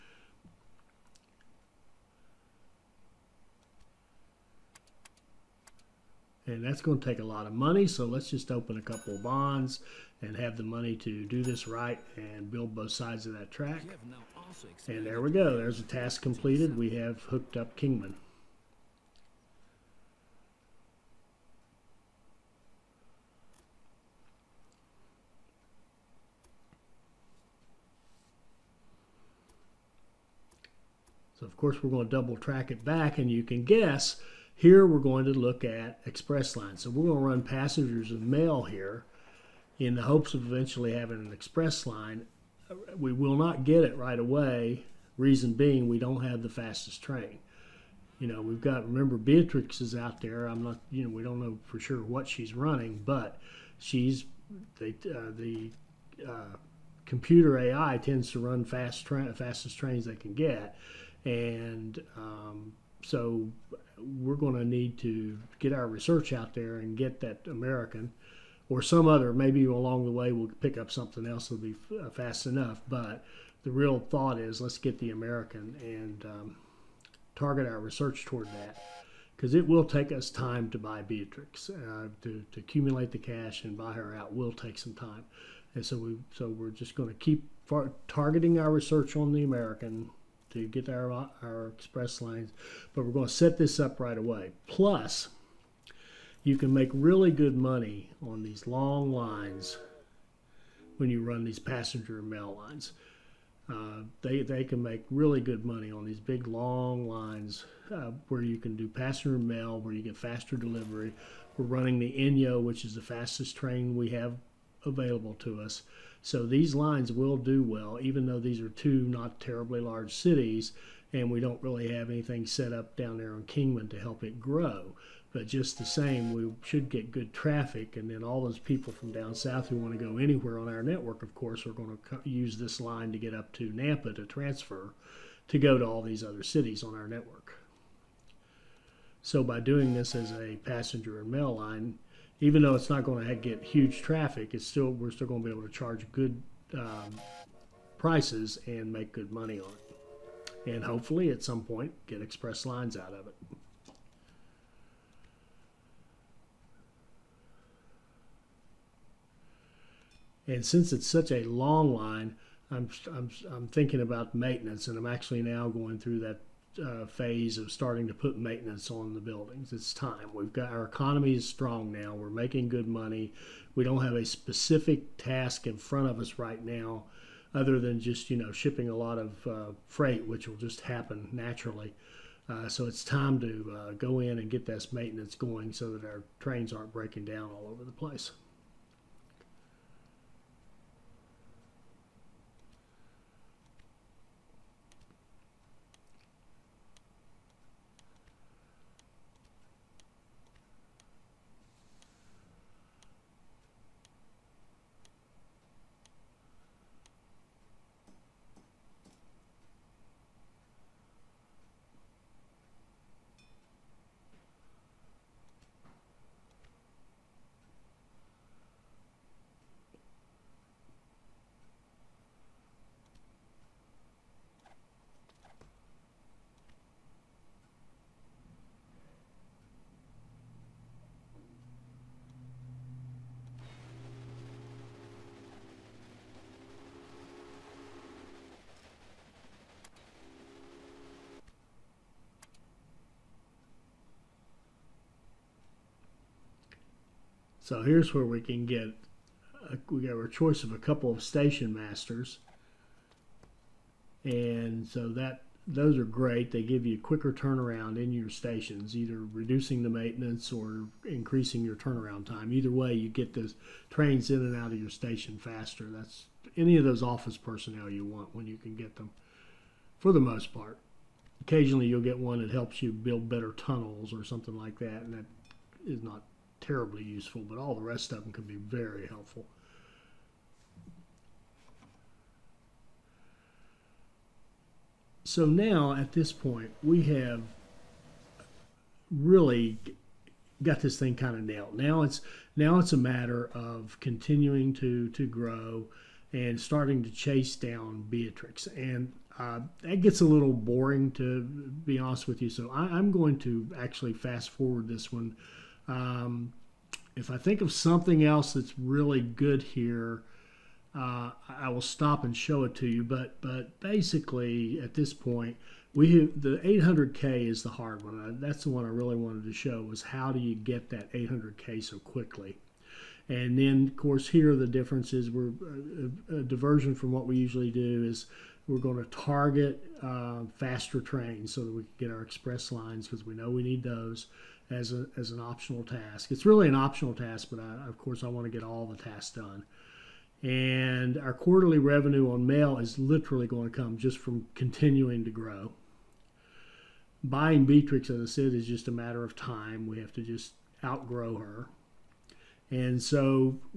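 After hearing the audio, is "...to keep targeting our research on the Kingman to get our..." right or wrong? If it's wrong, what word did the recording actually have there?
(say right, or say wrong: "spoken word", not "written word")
wrong: "American", not "Kingman".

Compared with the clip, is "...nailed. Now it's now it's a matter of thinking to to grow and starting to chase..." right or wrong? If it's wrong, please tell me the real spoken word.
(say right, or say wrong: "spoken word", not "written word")
wrong: "continuing", not "thinking".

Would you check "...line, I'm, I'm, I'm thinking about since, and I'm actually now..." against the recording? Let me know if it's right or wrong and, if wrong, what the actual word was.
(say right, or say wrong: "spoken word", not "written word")
wrong: "maintenance", not "since".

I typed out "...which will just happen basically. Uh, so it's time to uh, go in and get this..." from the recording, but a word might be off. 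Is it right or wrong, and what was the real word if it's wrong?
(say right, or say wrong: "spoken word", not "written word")
wrong: "naturally", not "basically".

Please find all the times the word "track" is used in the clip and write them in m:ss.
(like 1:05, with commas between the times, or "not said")
0:13, 0:32.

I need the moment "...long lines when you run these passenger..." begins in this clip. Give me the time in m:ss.
1:38.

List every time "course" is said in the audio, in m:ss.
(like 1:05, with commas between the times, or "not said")
0:31, 2:11, 5:23, 5:37.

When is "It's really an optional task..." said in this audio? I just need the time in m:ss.
5:36.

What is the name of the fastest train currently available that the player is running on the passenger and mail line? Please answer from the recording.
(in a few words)
Inyo.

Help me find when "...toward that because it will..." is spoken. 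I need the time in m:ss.
1:18.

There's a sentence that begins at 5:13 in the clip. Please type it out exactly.
But but basically, at this point, we the 800K is the hard one.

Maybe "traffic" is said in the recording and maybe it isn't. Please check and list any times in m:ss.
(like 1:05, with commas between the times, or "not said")
2:07, 2:24.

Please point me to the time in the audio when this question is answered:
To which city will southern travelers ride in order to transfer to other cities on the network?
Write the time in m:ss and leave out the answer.
2:13.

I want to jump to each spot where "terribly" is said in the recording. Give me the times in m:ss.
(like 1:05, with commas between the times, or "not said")
1:59, 4:36.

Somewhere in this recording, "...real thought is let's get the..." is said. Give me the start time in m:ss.
1:13.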